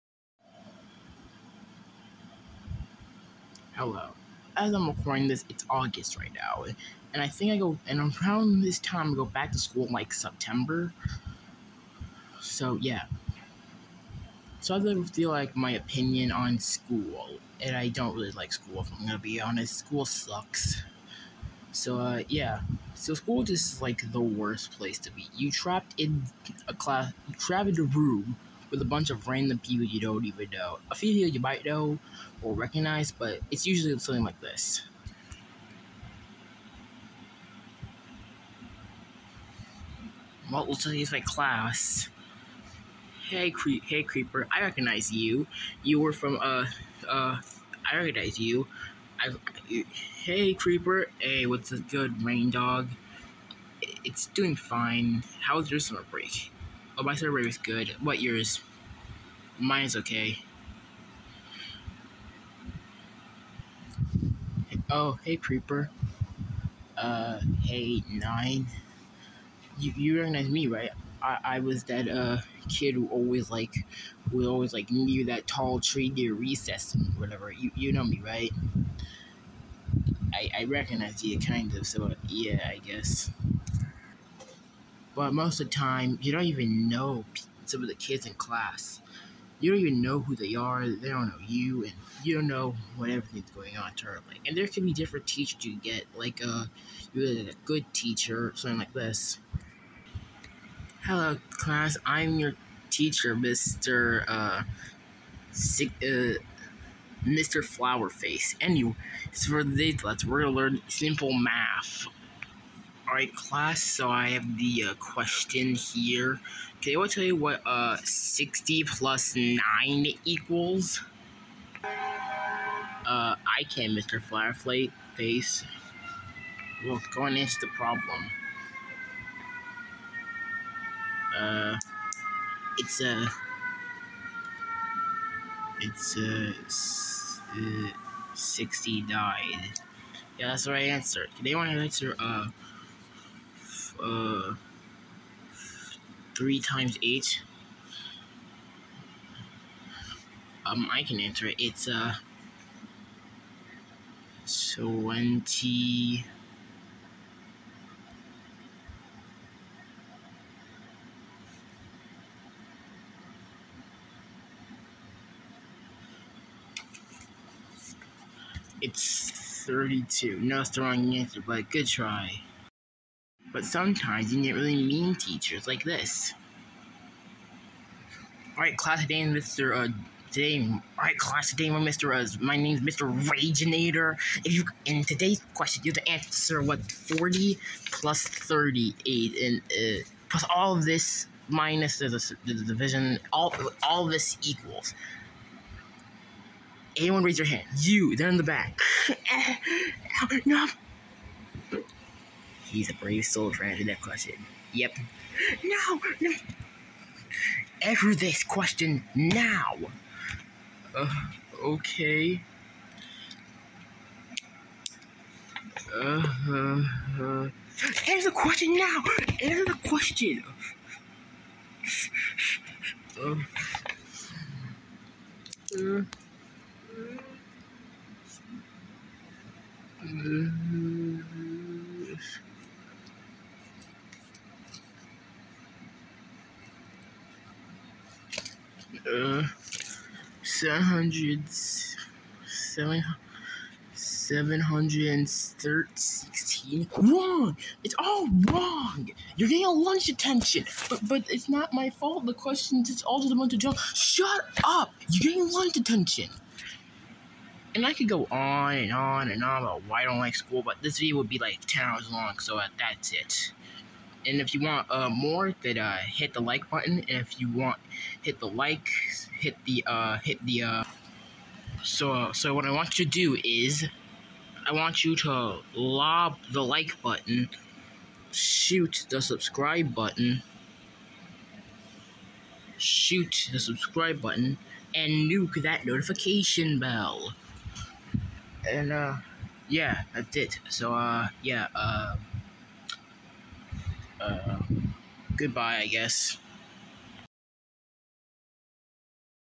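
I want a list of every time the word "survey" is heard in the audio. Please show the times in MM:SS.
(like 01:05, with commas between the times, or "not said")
00:57.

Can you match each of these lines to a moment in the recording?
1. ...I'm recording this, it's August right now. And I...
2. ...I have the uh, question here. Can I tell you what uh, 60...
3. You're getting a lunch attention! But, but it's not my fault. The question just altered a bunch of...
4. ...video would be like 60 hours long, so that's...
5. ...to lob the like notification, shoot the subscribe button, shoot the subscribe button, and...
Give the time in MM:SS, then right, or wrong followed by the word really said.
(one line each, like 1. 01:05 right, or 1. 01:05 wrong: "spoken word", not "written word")
1. 00:04 right
2. 01:54 right
3. 04:09 right
4. 04:20 wrong: "10", not "60"
5. 04:35 wrong: "button", not "notification".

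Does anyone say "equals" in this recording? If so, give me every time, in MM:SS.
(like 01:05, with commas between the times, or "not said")
02:00, 03:14.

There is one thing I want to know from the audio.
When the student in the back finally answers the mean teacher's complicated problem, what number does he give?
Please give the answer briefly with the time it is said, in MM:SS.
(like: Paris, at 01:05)
716, at 04:03.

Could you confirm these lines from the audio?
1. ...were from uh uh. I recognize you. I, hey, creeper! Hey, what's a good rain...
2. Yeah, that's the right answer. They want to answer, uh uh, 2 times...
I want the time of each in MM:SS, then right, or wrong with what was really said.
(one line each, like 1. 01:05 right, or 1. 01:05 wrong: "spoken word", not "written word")
1. 00:46 right
2. 02:20 wrong: "3", not "2".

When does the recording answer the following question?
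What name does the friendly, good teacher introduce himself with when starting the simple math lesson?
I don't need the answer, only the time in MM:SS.
01:45.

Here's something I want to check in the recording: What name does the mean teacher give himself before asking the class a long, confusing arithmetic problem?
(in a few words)
Mr. Raginator.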